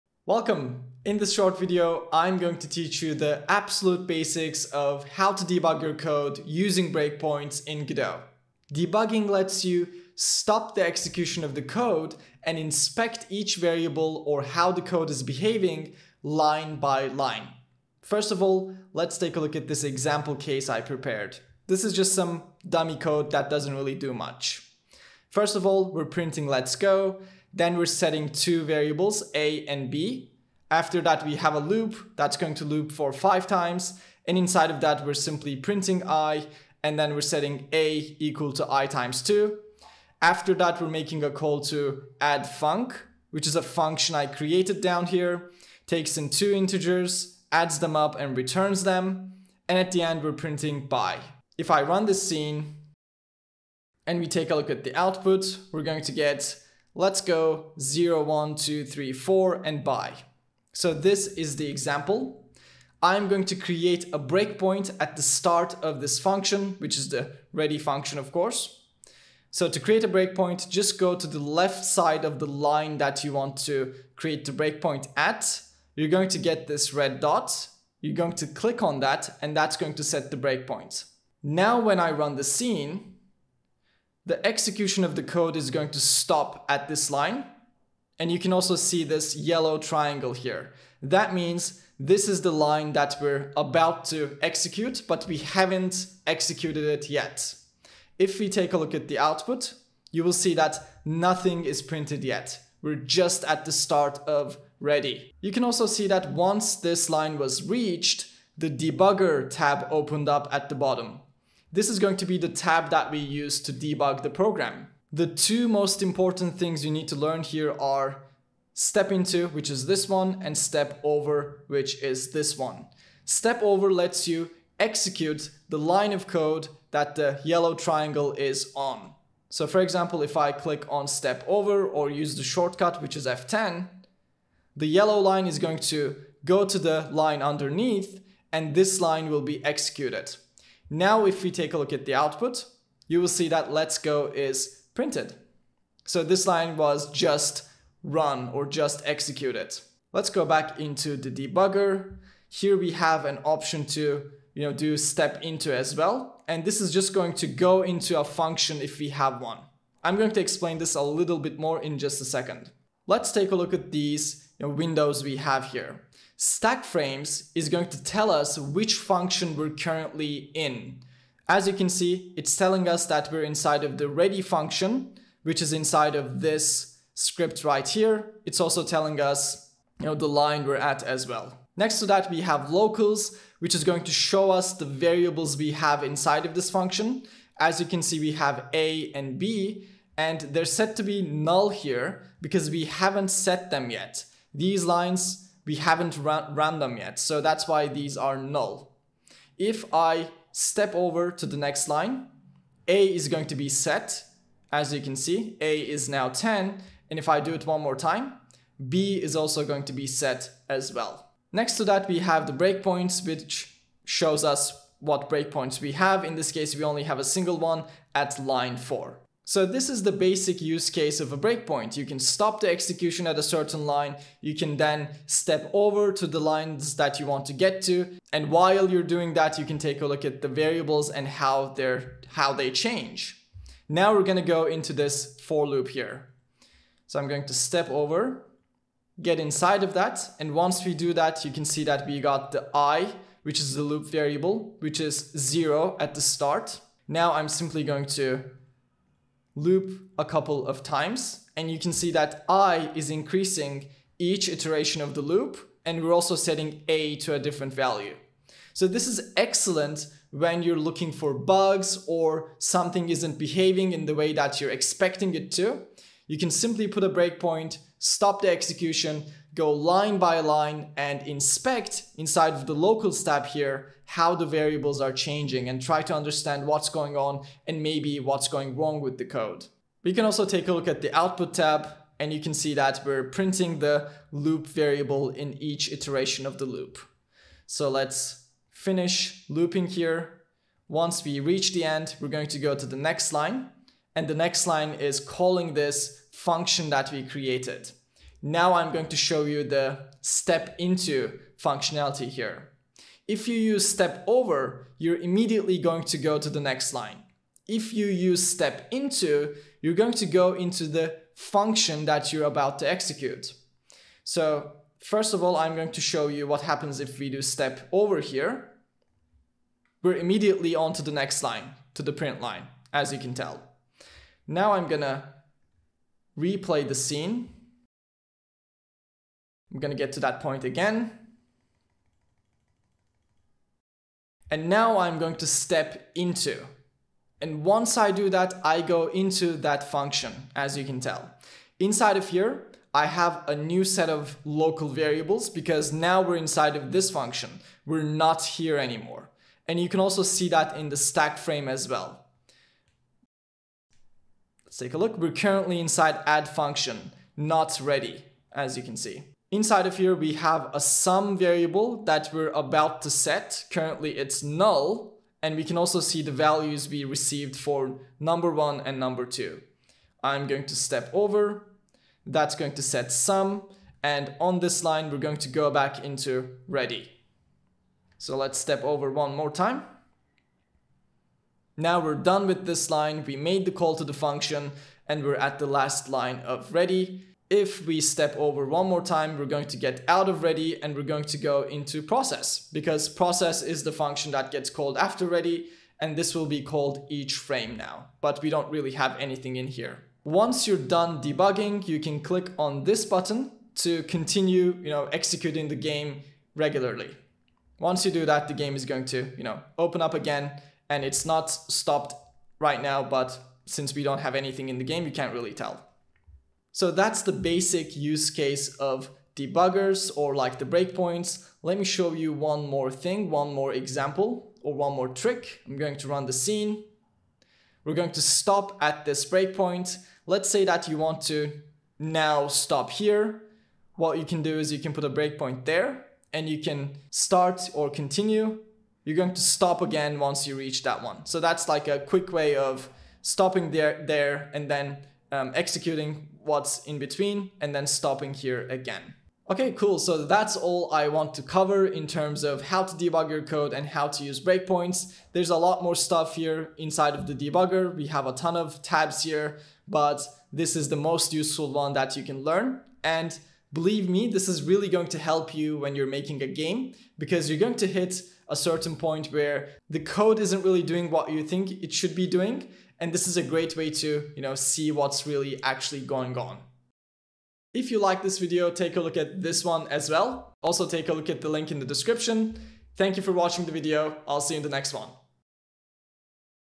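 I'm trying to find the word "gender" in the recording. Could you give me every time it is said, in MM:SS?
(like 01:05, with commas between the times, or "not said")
not said.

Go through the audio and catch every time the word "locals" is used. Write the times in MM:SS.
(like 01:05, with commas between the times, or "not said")
03:02, 04:32, 05:44.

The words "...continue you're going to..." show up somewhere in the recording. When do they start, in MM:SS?
07:17.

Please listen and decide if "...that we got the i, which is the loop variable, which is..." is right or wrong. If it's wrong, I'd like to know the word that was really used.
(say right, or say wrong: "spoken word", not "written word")
right.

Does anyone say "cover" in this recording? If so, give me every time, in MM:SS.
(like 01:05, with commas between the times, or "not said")
07:31.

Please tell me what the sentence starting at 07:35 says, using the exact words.
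There's a lot more stuff here inside of the debugger.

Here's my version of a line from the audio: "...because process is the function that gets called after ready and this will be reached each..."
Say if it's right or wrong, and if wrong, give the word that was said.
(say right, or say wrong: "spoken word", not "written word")
wrong: "called", not "reached".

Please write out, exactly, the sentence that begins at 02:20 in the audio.
Now, if we take a look at the output, you will see that let's go is printed.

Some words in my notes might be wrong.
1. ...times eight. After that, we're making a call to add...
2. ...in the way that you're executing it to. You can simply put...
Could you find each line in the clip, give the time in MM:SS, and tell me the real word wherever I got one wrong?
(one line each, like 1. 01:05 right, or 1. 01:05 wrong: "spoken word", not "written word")
1. 00:38 wrong: "two", not "eight"
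2. 04:23 wrong: "expecting", not "executing".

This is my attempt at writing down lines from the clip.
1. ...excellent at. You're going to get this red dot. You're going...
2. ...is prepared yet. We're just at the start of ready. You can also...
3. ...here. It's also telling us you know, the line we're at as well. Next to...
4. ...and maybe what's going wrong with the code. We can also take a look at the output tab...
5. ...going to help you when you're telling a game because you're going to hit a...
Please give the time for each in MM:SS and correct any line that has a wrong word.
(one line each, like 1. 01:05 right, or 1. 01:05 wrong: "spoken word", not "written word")
1. 01:14 wrong: "breakpoint", not "excellent"
2. 01:41 wrong: "printed", not "prepared"
3. 02:57 right
4. 04:37 right
5. 07:44 wrong: "making", not "telling".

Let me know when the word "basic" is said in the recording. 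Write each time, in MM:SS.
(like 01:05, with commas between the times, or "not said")
00:04, 03:40, 06:57.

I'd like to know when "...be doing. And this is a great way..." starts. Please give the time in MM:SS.
07:52.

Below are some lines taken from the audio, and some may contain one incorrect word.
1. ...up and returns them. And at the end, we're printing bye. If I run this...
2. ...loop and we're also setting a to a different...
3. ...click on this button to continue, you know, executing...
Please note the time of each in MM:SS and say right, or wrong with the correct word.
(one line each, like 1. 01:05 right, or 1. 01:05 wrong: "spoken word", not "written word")
1. 00:47 right
2. 04:15 right
3. 06:42 right.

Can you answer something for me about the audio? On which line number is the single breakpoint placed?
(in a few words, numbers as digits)
4.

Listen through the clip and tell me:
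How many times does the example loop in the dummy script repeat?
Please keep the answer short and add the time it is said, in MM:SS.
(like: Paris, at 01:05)
5, at 00:33.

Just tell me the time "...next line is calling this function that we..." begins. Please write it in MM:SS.
04:54.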